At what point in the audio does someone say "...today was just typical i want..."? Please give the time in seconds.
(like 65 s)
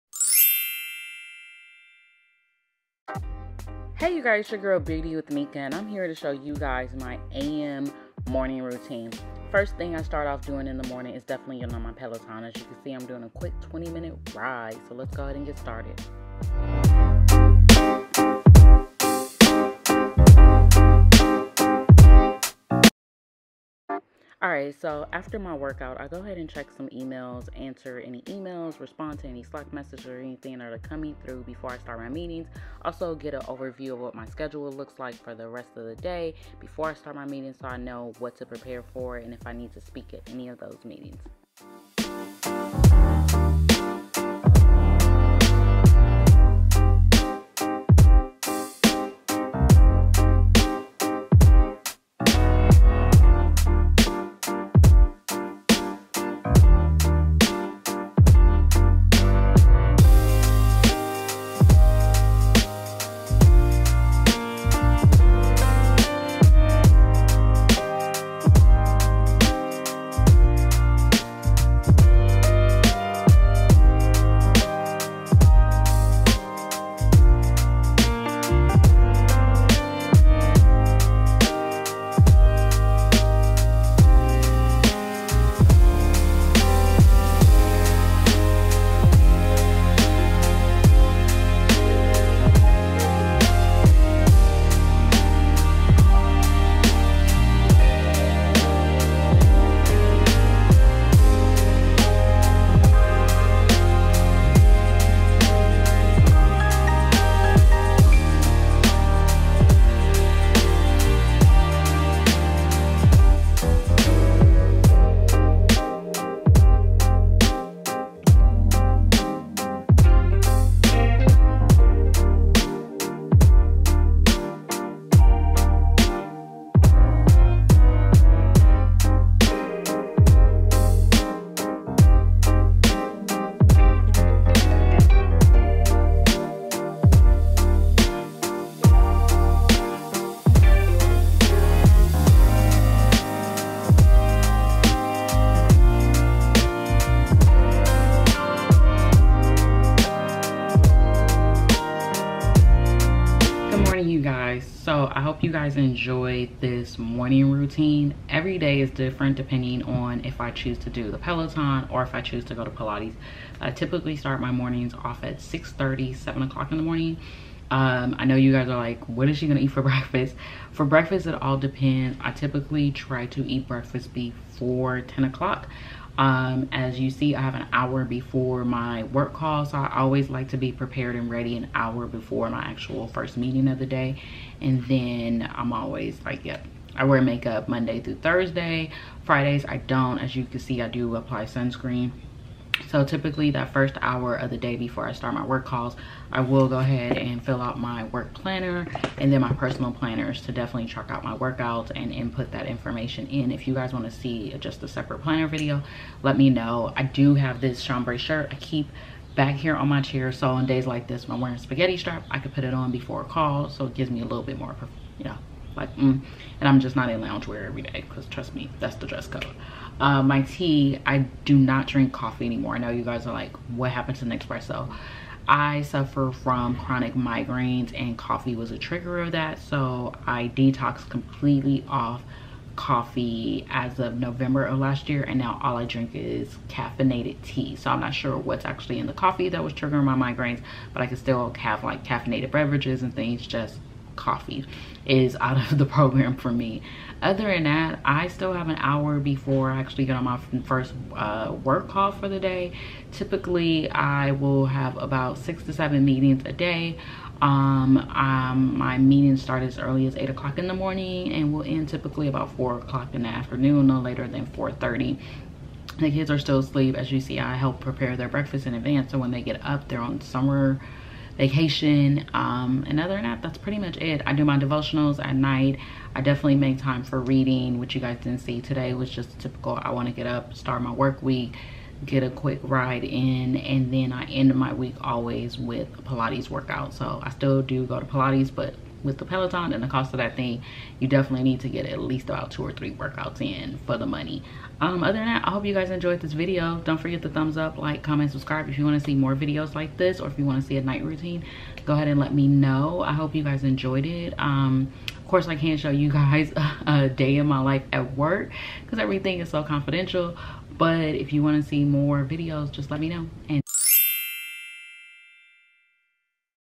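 278 s.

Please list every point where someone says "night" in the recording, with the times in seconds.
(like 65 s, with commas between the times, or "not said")
275 s, 300 s.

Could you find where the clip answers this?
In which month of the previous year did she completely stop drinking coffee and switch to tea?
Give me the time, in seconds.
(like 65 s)
234 s.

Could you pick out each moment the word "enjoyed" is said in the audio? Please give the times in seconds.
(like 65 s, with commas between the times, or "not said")
155 s, 295 s, 303 s.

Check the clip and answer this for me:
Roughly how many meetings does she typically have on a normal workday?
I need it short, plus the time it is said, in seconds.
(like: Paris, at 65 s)
6 to 7, at 255 s.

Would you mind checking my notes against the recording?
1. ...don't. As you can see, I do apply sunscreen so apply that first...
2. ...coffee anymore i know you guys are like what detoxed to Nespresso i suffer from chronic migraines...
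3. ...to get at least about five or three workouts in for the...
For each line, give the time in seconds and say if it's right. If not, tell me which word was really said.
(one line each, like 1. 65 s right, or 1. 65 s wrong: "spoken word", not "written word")
1. 189 s wrong: "typically", not "apply"
2. 222 s wrong: "happened", not "detoxed"
3. 291 s wrong: "two", not "five".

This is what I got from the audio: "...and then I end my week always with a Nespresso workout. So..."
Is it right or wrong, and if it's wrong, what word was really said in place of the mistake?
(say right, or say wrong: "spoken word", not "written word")
wrong: "Pilates", not "Nespresso".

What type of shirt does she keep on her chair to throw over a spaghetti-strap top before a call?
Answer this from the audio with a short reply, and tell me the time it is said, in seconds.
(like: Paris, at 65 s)
Chambray shirt, at 207 s.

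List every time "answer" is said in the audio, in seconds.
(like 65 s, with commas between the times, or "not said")
27 s.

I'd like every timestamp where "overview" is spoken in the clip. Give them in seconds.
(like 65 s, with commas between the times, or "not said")
33 s.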